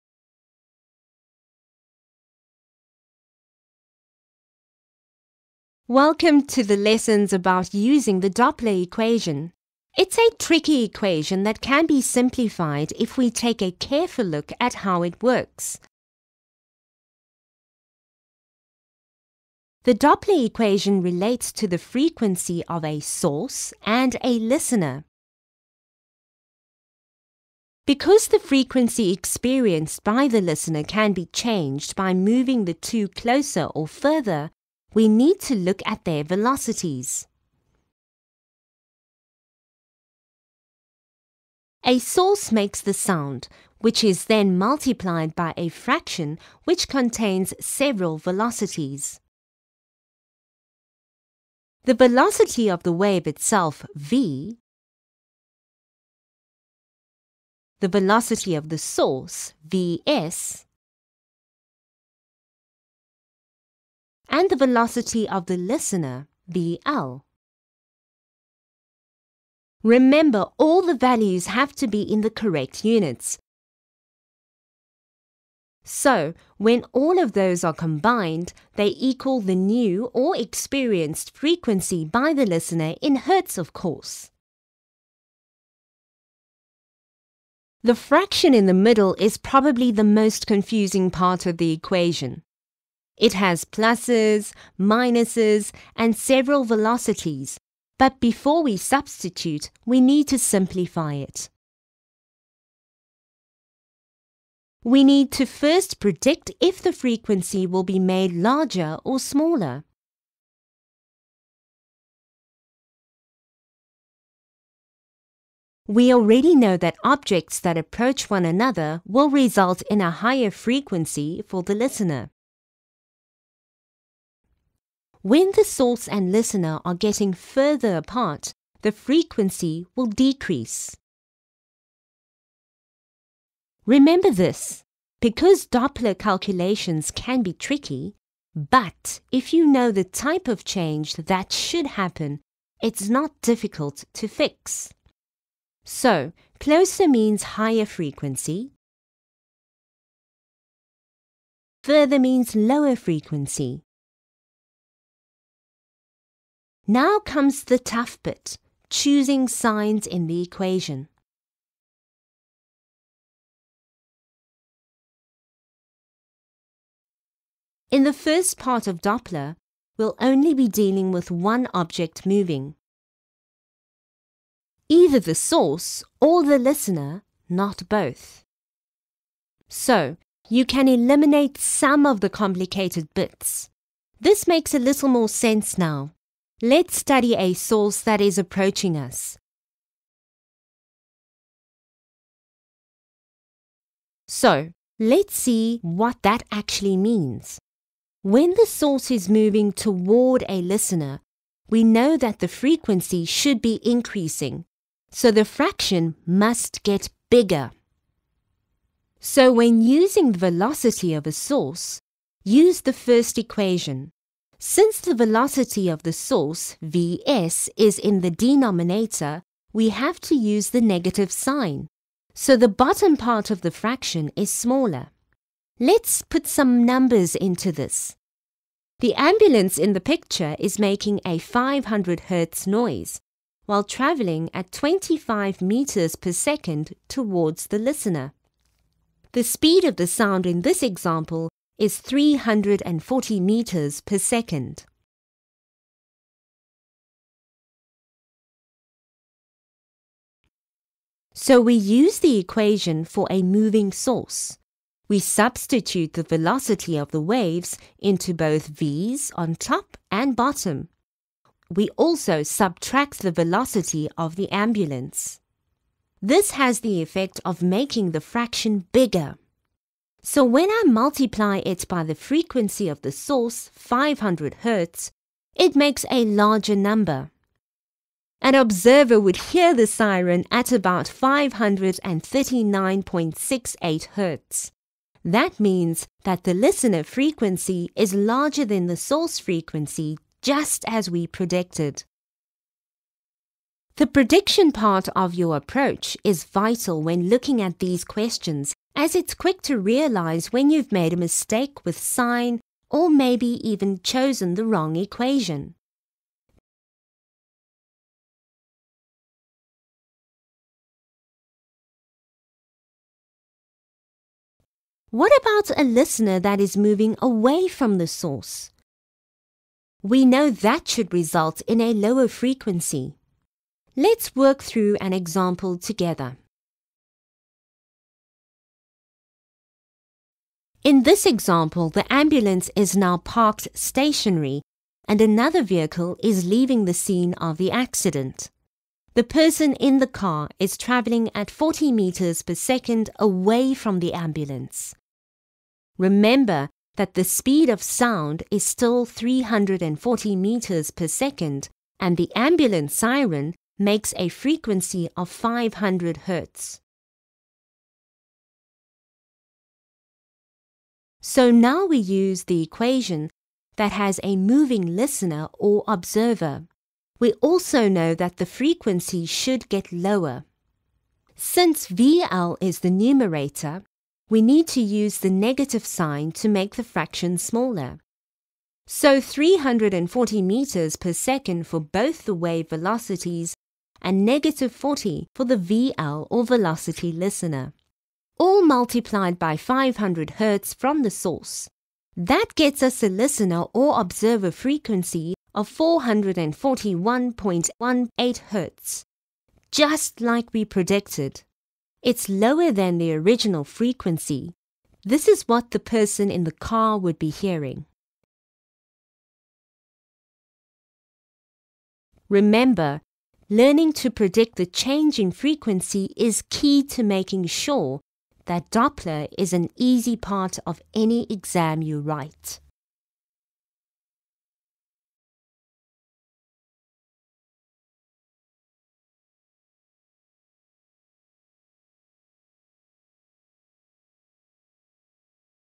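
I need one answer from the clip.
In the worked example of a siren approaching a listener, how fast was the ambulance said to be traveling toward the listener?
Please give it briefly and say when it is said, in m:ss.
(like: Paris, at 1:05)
25 meters per second, at 3:54.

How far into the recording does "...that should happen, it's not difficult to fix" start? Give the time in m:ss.
2:21.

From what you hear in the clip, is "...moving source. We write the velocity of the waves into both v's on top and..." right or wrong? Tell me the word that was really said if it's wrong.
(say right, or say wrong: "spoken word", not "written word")
wrong: "substitute", not "write".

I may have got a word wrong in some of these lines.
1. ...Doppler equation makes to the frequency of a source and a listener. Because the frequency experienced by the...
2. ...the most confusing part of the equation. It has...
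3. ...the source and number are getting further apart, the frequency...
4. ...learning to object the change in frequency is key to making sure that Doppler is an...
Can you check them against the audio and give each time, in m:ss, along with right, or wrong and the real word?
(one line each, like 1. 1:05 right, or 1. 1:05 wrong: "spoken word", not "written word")
1. 0:19 wrong: "relates", not "makes"
2. 1:29 right
3. 2:05 wrong: "listener", not "number"
4. 6:53 wrong: "predict", not "object".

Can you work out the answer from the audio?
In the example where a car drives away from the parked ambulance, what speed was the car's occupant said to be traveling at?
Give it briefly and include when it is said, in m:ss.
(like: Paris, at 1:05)
40 meters per second, at 5:41.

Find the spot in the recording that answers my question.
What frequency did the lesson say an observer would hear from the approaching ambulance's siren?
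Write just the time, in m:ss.
4:41.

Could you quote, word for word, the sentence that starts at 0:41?
A source makes the sound, which is then multiplied by a fraction which contains several velocities.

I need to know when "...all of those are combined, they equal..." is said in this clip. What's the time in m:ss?
1:16.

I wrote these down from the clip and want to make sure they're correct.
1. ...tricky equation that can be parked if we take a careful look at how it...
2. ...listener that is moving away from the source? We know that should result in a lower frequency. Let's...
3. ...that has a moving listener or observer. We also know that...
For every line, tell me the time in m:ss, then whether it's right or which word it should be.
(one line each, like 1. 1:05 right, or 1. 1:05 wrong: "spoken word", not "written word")
1. 0:10 wrong: "simplified", not "parked"
2. 5:15 right
3. 6:03 right.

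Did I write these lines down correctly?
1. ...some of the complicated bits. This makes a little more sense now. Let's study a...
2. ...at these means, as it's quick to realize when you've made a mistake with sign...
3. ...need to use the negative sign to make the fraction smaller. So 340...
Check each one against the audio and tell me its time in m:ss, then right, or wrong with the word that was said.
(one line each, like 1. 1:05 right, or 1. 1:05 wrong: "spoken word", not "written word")
1. 3:01 right
2. 4:57 wrong: "questions", not "means"
3. 6:14 right.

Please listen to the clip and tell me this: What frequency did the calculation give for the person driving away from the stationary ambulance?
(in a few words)
441.18 Hz.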